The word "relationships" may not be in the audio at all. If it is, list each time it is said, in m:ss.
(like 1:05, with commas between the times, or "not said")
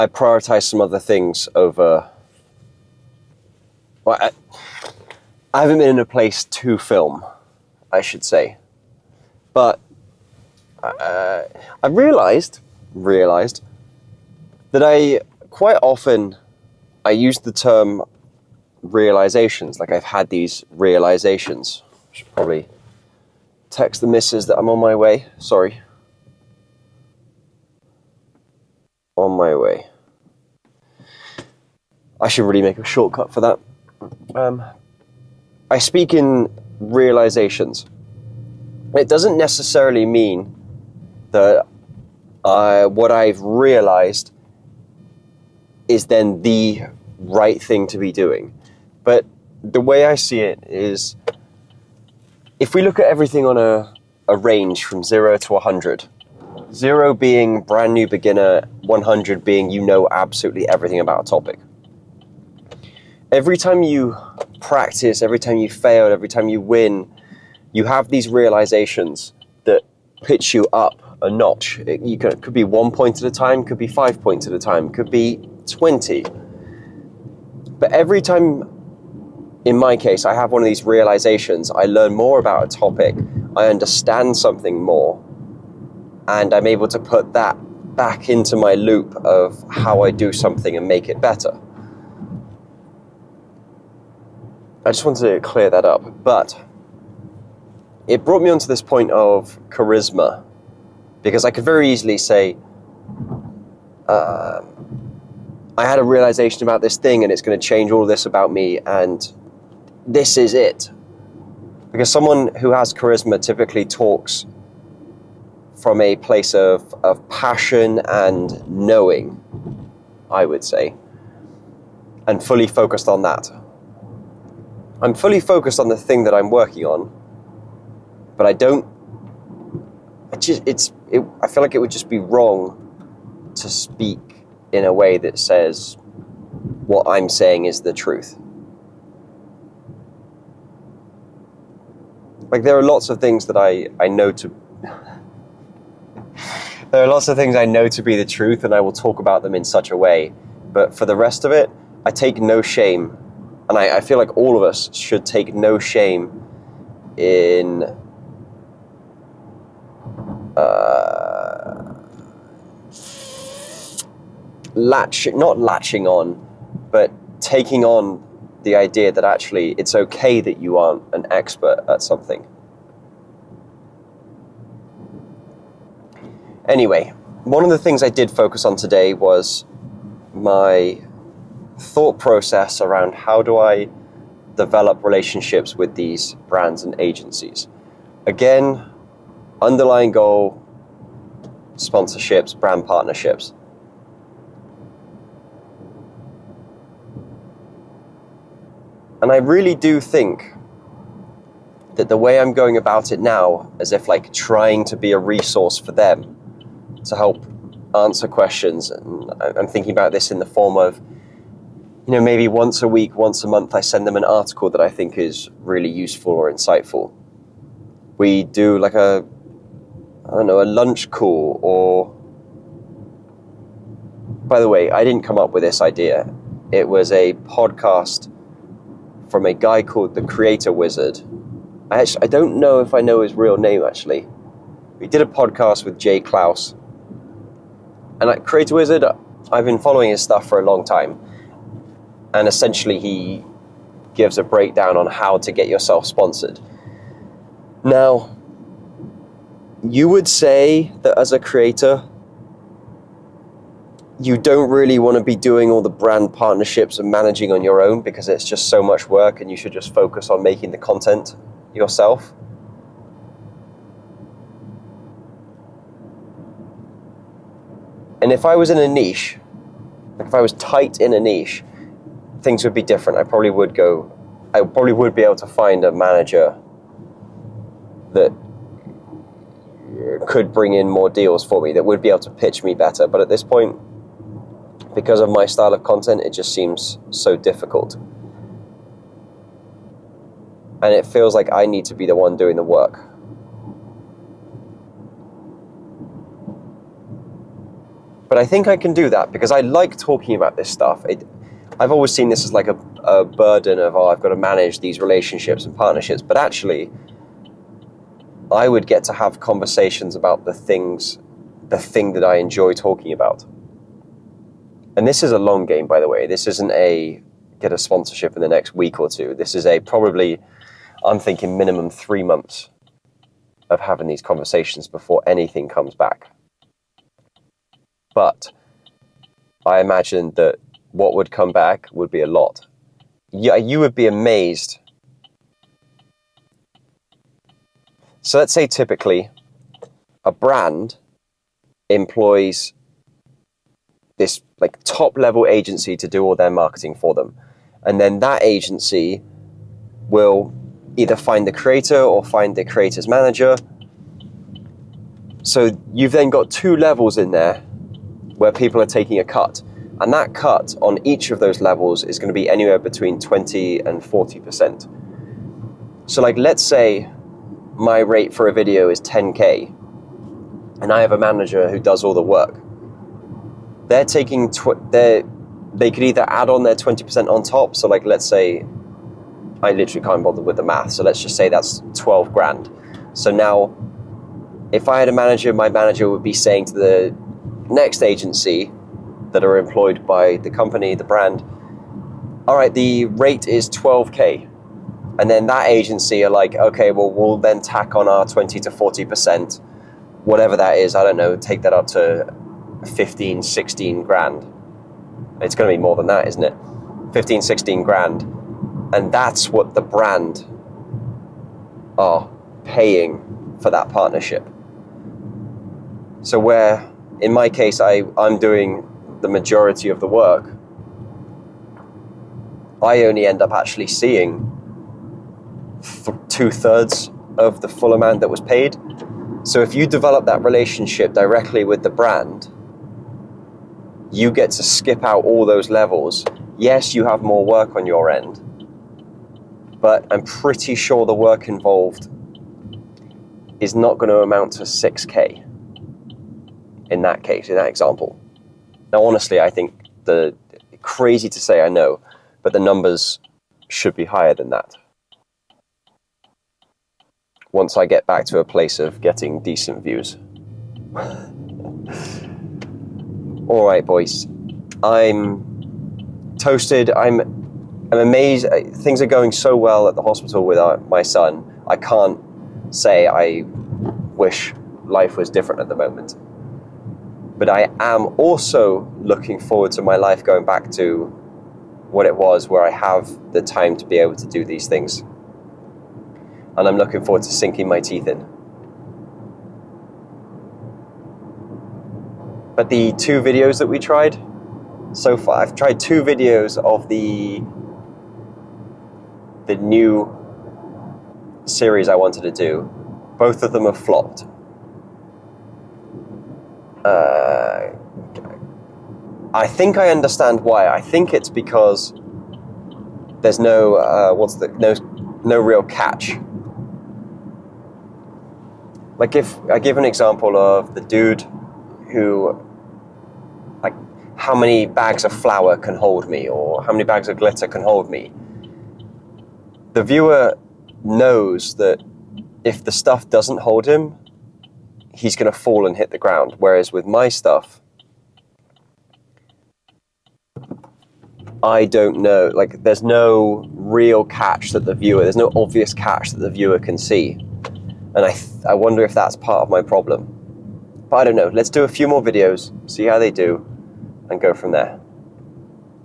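3:05, 5:04, 7:10.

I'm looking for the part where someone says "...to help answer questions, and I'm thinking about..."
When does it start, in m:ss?
3:27.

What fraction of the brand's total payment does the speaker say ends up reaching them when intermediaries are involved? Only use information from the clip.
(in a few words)
two thirds.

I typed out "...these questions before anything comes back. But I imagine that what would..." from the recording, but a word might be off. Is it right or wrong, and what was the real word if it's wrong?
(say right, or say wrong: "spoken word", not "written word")
wrong: "conversations", not "questions".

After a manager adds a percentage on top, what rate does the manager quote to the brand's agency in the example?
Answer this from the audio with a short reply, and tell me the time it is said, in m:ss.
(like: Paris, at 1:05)
12k, at 6:32.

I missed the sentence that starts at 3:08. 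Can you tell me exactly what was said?
Again, underlying goal sponsorships, brand partnerships.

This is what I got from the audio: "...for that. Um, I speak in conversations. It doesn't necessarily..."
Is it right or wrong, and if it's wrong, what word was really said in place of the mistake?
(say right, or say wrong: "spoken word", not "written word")
wrong: "realizations", not "conversations".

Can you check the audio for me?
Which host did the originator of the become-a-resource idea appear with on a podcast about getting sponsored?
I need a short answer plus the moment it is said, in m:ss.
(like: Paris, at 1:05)
Jay Clouse, at 3:55.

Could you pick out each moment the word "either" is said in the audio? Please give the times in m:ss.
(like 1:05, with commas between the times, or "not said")
5:50, 6:16.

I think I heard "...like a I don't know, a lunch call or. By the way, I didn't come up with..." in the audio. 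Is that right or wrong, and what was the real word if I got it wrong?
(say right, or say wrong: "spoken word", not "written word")
right.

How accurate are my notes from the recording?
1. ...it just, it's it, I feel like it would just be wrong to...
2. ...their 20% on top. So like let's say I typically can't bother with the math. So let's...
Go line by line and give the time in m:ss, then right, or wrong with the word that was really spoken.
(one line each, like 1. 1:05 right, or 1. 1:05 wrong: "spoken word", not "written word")
1. 2:10 right
2. 6:16 wrong: "literally", not "typically".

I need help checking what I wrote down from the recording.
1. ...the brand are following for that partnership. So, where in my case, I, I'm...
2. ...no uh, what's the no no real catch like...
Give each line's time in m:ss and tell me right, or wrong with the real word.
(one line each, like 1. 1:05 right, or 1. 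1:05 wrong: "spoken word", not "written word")
1. 6:49 wrong: "paying", not "following"
2. 8:33 right.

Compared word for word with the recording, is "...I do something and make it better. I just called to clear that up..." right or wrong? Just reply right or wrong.
wrong.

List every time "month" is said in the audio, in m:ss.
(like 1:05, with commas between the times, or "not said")
3:33, 5:22.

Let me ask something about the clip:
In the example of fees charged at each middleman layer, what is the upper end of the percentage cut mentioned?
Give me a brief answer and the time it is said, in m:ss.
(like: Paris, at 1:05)
40%, at 6:02.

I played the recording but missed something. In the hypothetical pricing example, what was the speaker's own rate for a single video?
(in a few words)
10k.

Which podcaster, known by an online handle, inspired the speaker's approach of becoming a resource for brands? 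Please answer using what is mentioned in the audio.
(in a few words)
the Creator Wizard.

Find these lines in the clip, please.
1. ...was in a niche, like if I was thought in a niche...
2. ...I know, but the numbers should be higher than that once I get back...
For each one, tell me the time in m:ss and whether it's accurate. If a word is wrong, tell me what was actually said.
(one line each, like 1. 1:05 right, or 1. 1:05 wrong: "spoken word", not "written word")
1. 4:28 wrong: "tight", not "thought"
2. 7:31 right.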